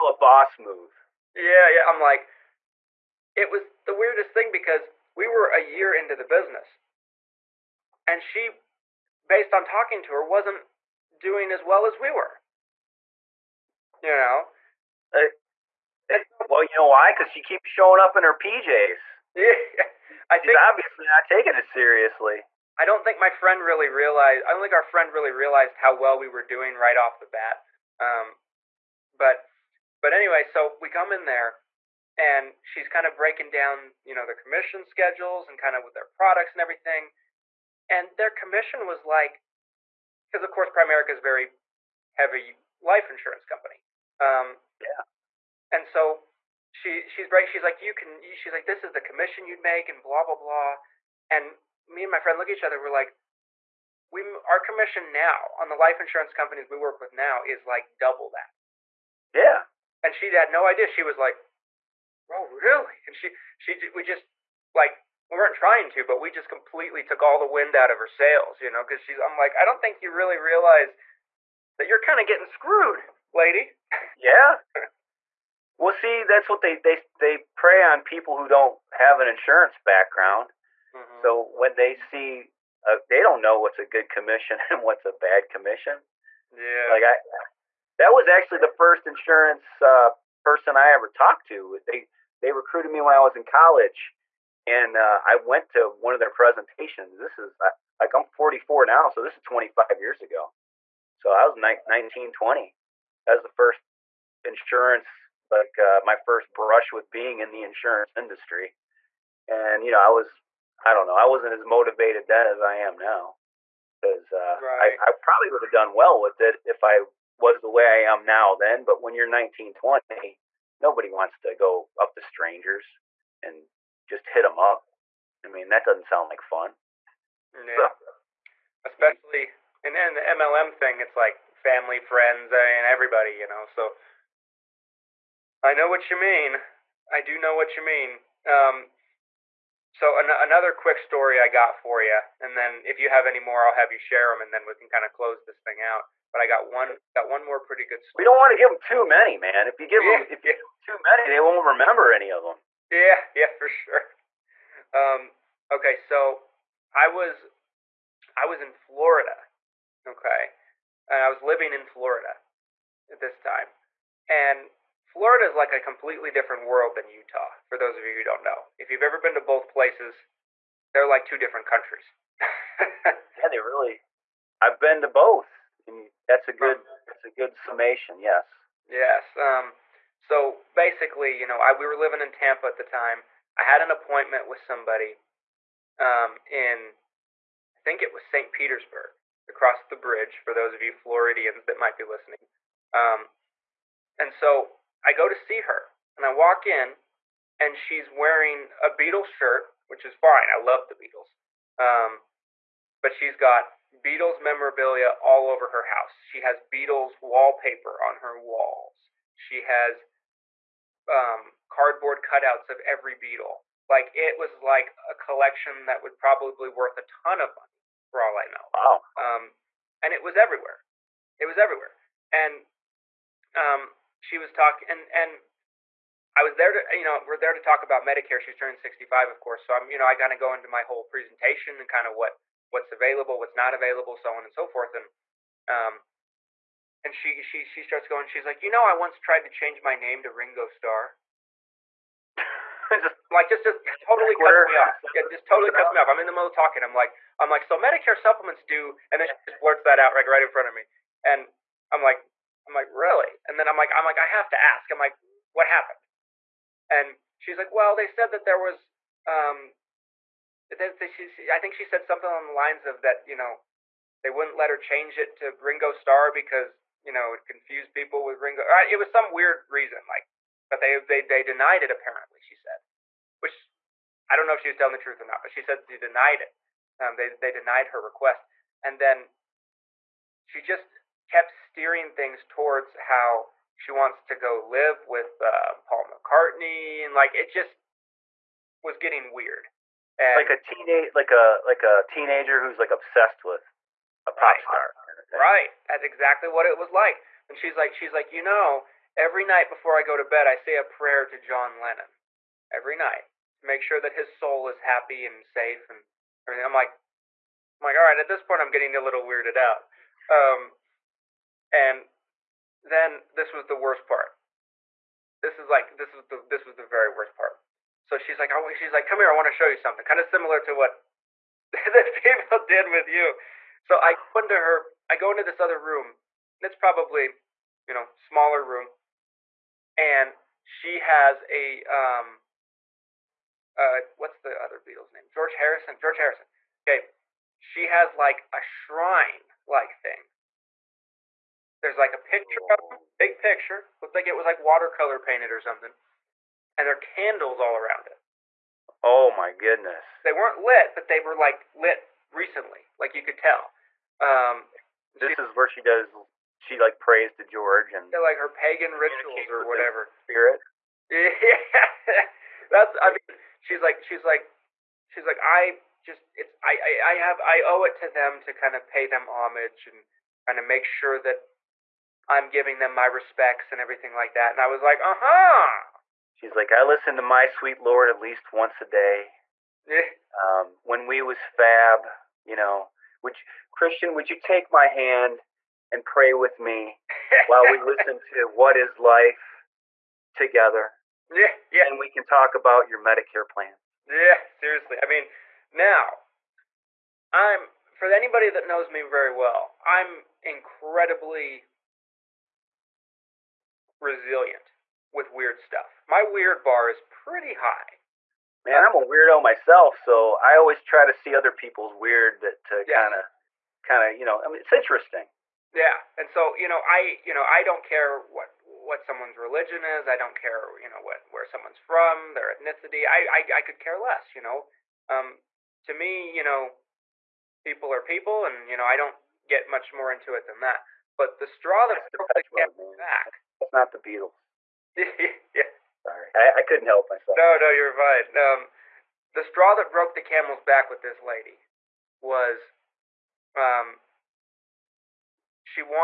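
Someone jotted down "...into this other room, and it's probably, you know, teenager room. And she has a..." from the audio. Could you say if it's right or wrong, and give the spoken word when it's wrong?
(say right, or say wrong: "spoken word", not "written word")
wrong: "smaller", not "teenager".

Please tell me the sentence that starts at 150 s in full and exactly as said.
too many, they won't remember any of them.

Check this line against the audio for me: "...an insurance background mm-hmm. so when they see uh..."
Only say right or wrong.
right.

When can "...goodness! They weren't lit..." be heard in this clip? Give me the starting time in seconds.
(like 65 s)
349 s.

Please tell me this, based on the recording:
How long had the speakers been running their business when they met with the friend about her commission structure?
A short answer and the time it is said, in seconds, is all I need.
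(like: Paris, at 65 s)
A year, at 5 s.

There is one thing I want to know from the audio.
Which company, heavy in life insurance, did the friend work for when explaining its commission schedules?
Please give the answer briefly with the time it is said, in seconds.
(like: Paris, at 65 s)
Primerica, at 40 s.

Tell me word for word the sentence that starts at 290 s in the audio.
And like a teenage, like a like a teenager who's like obsessed with a pop right.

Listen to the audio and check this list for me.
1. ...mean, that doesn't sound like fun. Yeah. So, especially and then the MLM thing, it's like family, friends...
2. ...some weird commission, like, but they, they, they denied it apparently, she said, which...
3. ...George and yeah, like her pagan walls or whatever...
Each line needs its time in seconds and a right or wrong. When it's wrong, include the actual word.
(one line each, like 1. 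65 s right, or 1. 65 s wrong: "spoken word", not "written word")
1. 125 s right
2. 269 s wrong: "reason", not "commission"
3. 357 s wrong: "rituals", not "walls".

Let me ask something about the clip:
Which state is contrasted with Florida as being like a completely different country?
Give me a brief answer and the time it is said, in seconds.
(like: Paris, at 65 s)
Utah, at 167 s.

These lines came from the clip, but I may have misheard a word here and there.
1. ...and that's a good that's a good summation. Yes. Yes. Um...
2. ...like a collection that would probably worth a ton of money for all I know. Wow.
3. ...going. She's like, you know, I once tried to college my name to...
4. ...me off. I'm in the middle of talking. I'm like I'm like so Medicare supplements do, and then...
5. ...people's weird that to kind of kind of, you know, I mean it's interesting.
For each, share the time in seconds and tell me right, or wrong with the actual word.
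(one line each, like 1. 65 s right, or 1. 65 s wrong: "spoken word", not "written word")
1. 175 s right
2. 214 s right
3. 238 s wrong: "change", not "college"
4. 245 s right
5. 411 s right.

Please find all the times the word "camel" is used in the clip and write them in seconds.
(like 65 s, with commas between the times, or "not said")
432 s, 440 s.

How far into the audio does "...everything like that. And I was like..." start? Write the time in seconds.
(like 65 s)
373 s.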